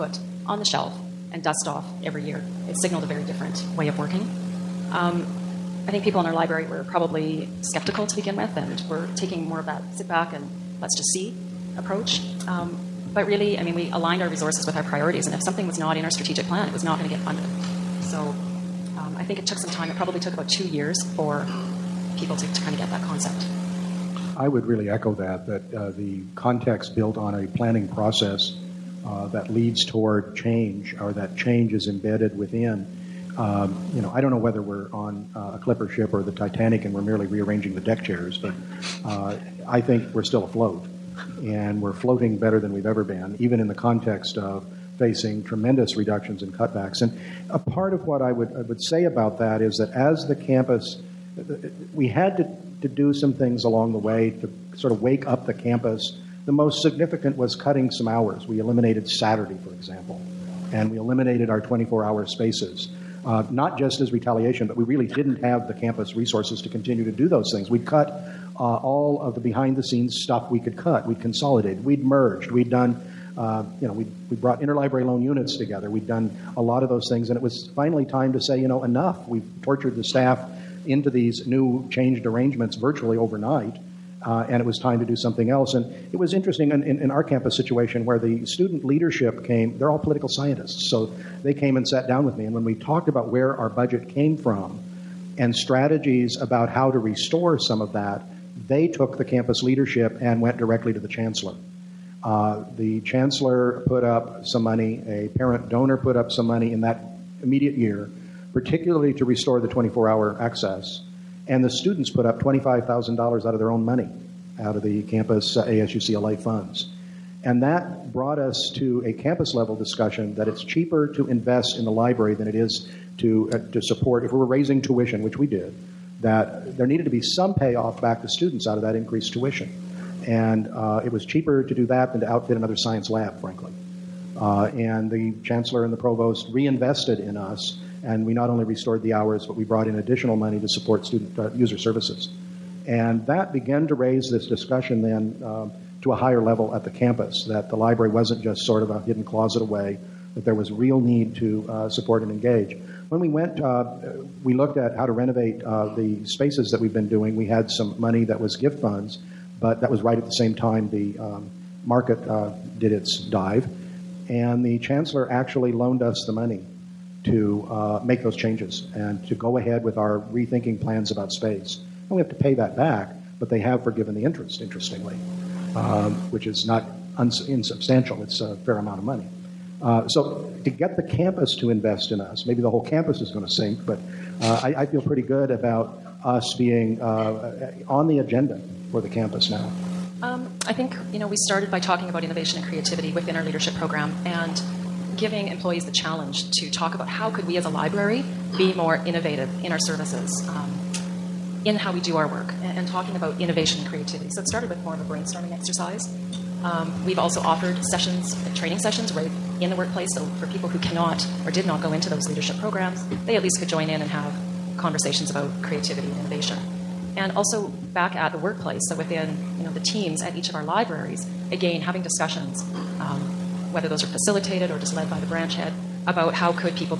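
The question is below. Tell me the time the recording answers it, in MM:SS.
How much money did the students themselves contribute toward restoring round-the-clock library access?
01:52.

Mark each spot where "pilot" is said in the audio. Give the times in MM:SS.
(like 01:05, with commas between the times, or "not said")
not said.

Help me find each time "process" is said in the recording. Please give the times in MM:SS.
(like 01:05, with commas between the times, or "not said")
00:27.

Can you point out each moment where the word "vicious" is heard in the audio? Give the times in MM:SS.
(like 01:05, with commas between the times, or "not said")
not said.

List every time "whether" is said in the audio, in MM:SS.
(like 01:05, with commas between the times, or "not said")
00:34, 03:43.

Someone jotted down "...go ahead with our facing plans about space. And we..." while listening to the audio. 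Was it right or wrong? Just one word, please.
wrong.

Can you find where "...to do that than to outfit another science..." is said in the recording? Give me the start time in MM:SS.
02:11.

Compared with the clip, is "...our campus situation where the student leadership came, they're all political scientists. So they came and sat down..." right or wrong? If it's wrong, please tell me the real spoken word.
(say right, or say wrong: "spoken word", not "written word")
right.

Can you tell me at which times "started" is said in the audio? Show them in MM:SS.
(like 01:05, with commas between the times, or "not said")
03:11, 03:24.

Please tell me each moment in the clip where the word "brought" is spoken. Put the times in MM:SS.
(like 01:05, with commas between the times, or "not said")
01:14, 01:58, 02:19.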